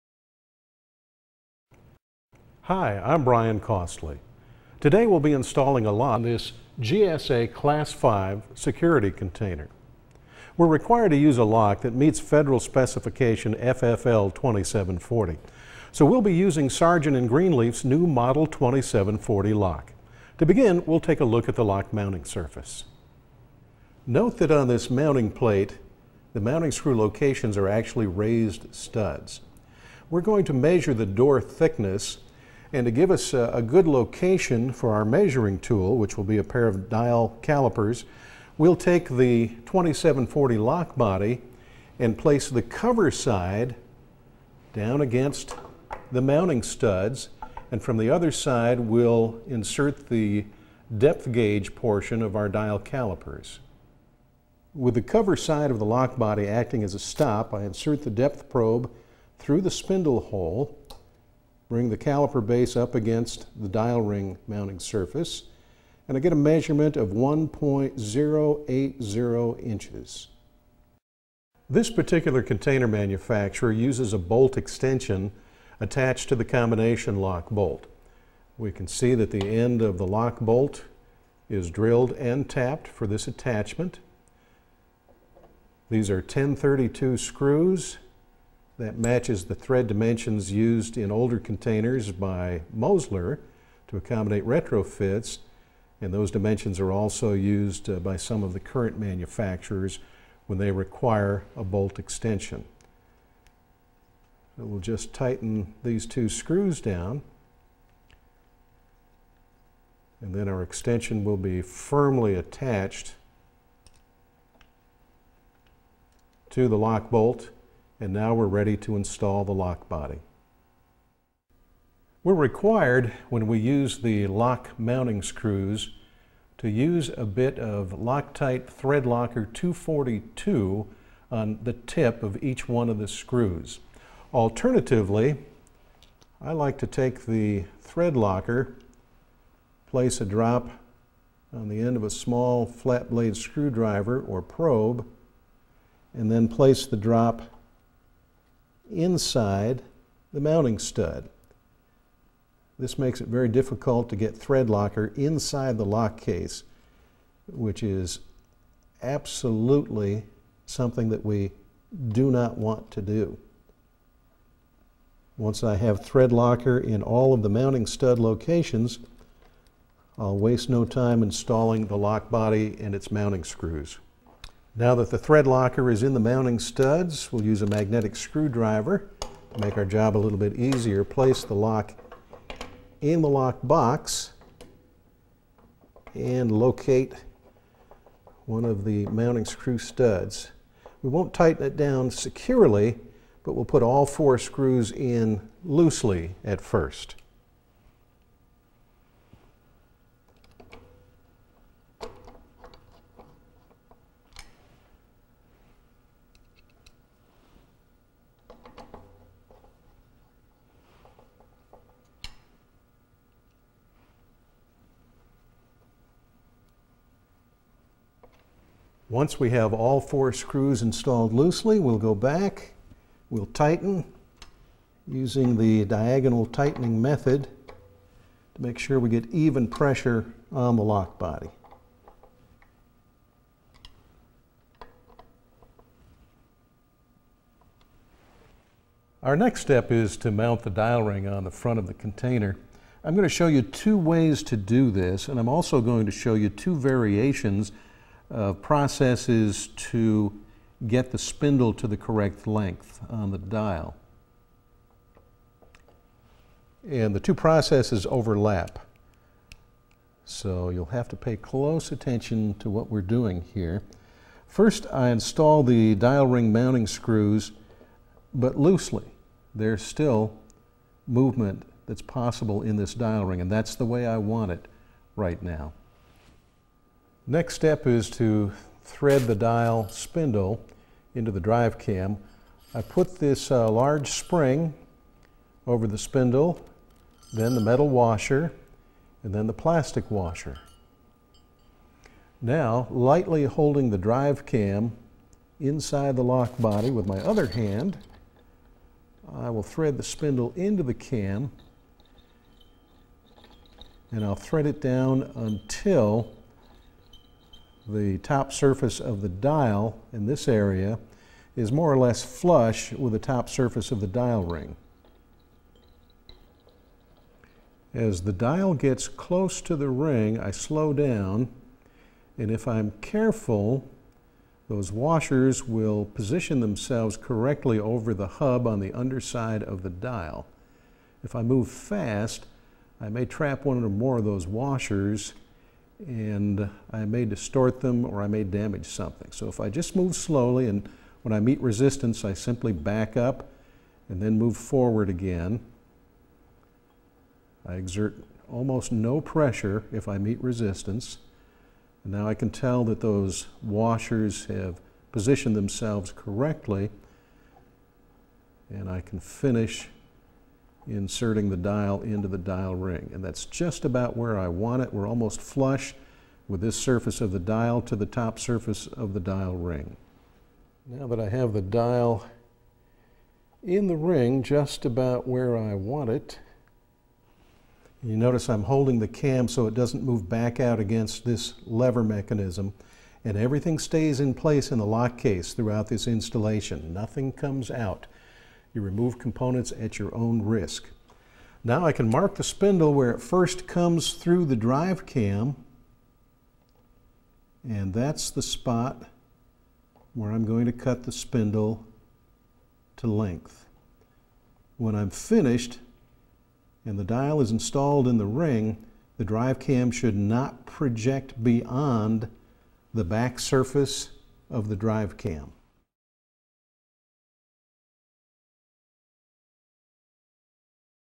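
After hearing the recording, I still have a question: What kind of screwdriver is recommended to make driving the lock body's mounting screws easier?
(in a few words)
magnetic screwdriver.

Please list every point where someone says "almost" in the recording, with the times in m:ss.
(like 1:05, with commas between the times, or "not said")
5:48, 6:05.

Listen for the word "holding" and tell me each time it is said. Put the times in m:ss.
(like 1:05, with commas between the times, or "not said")
4:53, 6:18.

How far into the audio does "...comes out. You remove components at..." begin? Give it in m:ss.
6:27.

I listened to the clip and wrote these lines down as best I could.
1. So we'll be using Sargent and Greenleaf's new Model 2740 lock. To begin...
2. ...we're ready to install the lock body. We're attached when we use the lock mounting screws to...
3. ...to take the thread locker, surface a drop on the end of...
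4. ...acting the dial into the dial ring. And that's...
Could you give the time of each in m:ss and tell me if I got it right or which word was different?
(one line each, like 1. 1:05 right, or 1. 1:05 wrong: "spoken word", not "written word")
1. 0:15 right
2. 1:58 wrong: "required", not "attached"
3. 2:16 wrong: "place", not "surface"
4. 6:00 wrong: "inserting", not "acting".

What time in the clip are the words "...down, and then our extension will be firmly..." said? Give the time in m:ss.
1:46.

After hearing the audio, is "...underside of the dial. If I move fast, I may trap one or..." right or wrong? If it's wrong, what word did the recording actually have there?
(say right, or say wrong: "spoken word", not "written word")
right.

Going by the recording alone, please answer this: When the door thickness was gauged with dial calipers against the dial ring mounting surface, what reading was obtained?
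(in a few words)
1.080 inches.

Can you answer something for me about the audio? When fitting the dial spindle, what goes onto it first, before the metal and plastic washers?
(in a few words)
large spring.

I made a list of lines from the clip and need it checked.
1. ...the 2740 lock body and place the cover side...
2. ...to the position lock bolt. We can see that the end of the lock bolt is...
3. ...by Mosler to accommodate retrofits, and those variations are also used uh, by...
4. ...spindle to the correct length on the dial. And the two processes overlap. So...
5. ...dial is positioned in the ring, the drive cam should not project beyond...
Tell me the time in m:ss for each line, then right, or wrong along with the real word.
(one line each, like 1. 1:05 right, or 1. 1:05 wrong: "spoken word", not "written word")
1. 0:39 right
2. 1:16 wrong: "combination", not "position"
3. 1:32 wrong: "dimensions", not "variations"
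4. 4:11 right
5. 6:47 wrong: "installed", not "positioned".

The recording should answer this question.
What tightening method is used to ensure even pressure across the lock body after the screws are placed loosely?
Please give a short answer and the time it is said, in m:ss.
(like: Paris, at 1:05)
diagonal tightening method, at 3:45.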